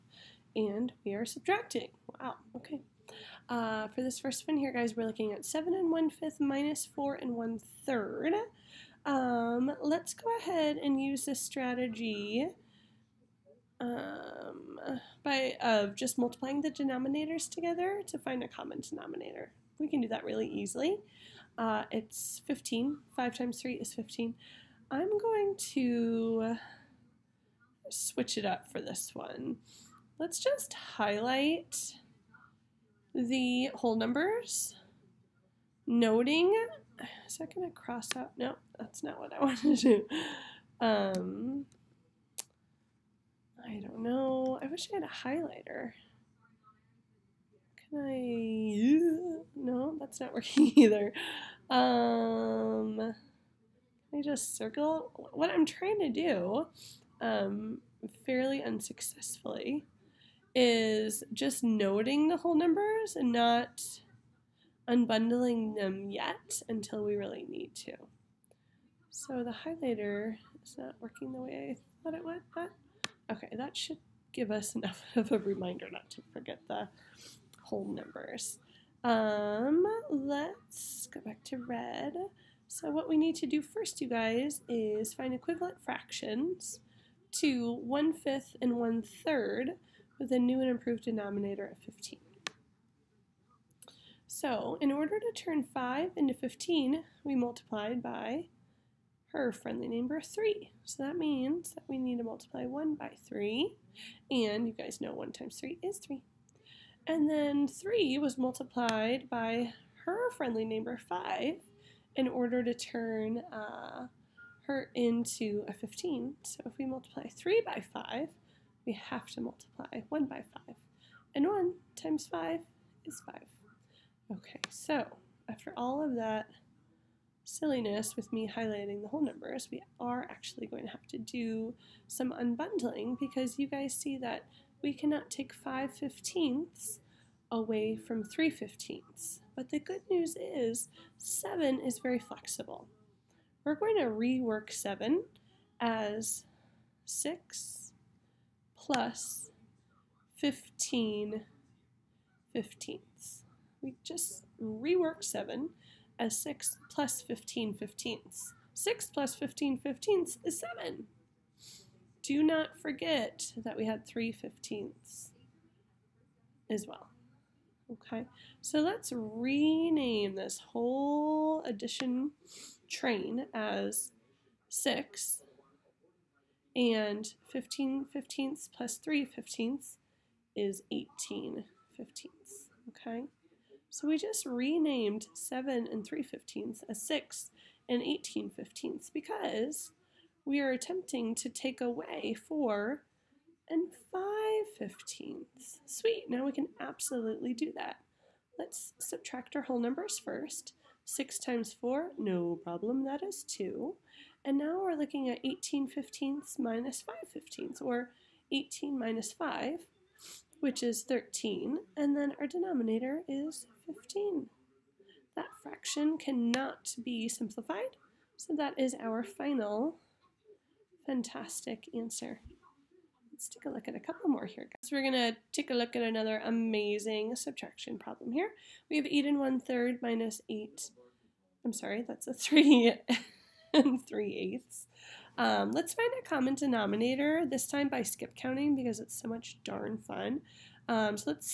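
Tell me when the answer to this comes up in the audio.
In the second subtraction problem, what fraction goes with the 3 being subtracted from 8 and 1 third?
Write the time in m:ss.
3:54.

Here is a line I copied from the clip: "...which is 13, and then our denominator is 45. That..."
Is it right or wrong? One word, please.
wrong.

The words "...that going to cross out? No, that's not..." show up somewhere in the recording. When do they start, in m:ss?
0:37.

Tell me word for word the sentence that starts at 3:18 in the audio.
Let's subtract our whole numbers first.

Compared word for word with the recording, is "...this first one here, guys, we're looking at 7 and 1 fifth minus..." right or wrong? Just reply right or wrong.
right.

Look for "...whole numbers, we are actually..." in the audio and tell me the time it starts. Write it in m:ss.
2:09.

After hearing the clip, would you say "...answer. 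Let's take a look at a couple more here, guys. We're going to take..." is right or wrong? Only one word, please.
right.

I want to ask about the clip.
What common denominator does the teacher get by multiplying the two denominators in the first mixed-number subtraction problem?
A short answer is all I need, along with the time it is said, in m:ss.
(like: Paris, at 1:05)
15, at 0:21.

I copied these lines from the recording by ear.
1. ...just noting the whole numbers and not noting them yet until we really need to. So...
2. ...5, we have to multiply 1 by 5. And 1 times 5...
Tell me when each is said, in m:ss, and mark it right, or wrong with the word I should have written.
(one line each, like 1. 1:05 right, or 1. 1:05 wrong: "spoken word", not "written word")
1. 1:01 wrong: "unbundling", not "noting"
2. 1:57 right.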